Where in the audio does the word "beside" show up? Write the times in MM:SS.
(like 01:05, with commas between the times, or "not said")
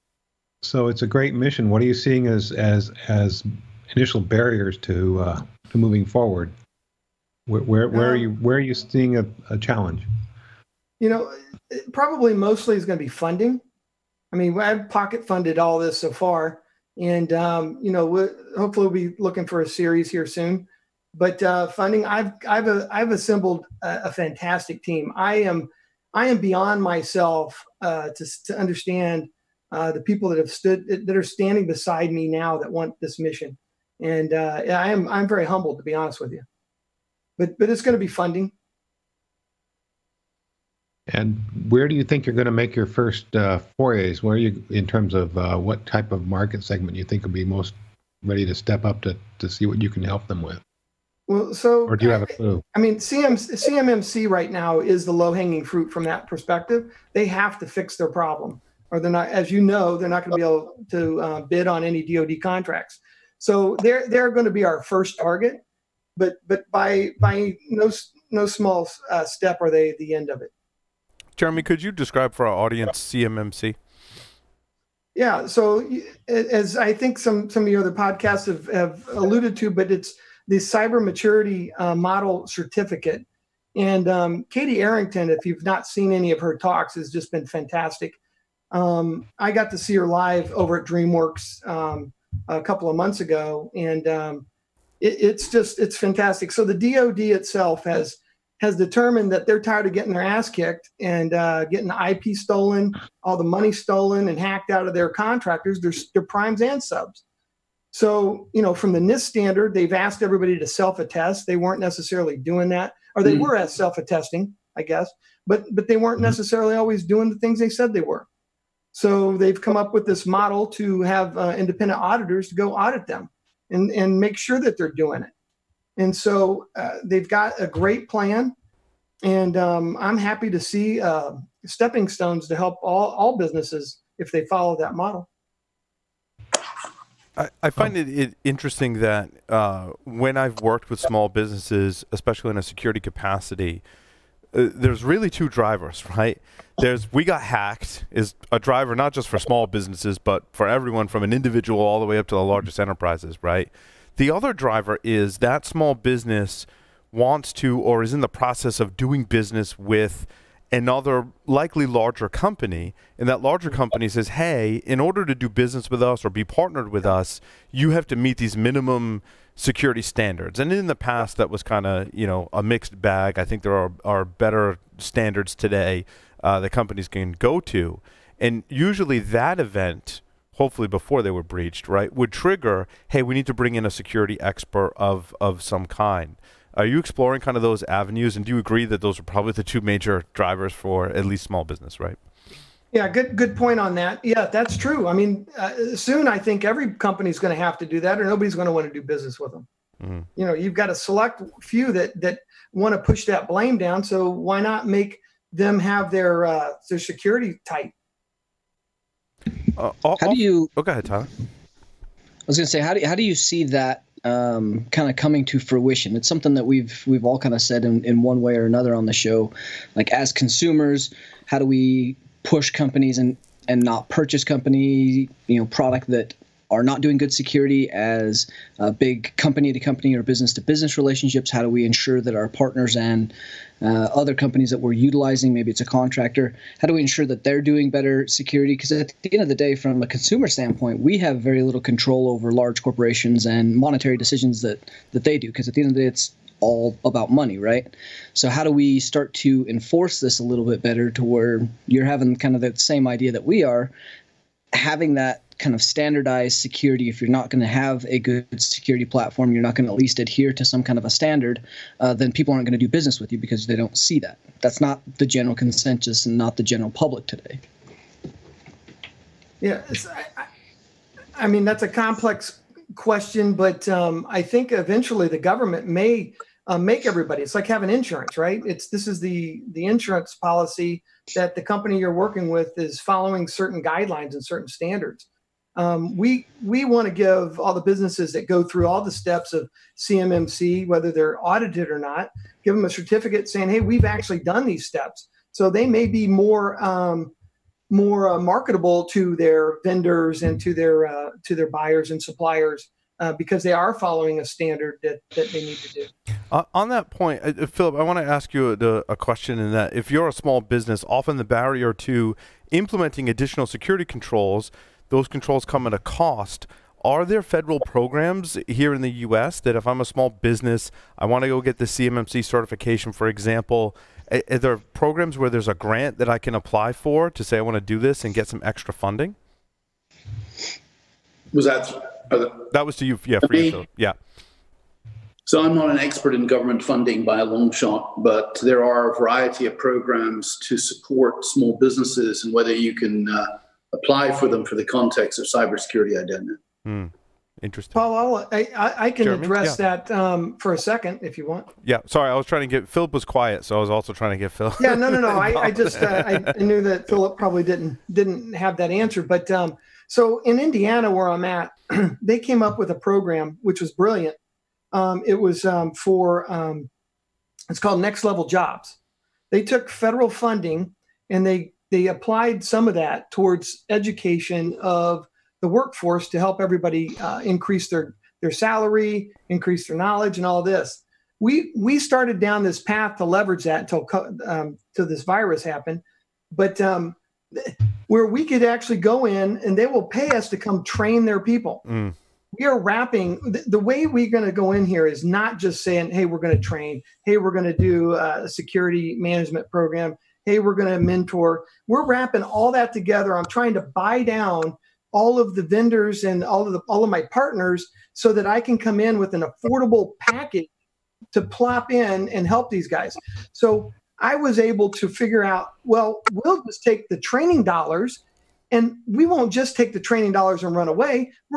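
00:31.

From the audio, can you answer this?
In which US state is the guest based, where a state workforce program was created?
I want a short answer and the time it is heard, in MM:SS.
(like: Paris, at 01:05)
Indiana, at 06:00.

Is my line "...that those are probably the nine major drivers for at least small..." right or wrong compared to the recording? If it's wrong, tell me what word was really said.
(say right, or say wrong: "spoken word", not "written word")
wrong: "two", not "nine".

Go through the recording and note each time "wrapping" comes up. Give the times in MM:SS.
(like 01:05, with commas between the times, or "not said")
06:32, 06:42.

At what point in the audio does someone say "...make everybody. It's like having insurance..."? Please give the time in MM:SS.
04:36.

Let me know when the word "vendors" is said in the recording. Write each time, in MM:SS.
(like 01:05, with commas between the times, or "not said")
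04:59, 06:45.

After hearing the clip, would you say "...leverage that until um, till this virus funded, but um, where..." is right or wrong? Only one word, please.
wrong.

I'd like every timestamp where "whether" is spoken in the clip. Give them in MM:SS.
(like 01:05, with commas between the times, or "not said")
04:50, 05:42.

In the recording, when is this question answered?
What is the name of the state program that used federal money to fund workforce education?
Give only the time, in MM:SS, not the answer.
06:08.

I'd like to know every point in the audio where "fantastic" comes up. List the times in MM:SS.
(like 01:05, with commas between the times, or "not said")
00:24, 01:27, 01:35.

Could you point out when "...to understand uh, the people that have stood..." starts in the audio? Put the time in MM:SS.
00:28.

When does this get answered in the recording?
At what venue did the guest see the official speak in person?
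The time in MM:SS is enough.
01:30.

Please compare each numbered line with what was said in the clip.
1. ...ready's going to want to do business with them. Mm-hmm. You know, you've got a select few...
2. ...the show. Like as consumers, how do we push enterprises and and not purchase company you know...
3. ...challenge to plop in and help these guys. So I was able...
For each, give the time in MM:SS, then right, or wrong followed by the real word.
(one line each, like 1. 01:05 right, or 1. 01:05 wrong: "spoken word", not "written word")
1. 03:18 wrong: "nobody", not "ready"
2. 03:39 wrong: "companies", not "enterprises"
3. 06:50 wrong: "package", not "challenge".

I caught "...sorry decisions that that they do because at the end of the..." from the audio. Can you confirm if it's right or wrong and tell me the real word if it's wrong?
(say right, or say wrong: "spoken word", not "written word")
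wrong: "monetary", not "sorry".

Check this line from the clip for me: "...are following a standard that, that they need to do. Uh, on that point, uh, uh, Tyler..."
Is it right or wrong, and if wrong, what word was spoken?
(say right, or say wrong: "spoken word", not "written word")
wrong: "Philip", not "Tyler".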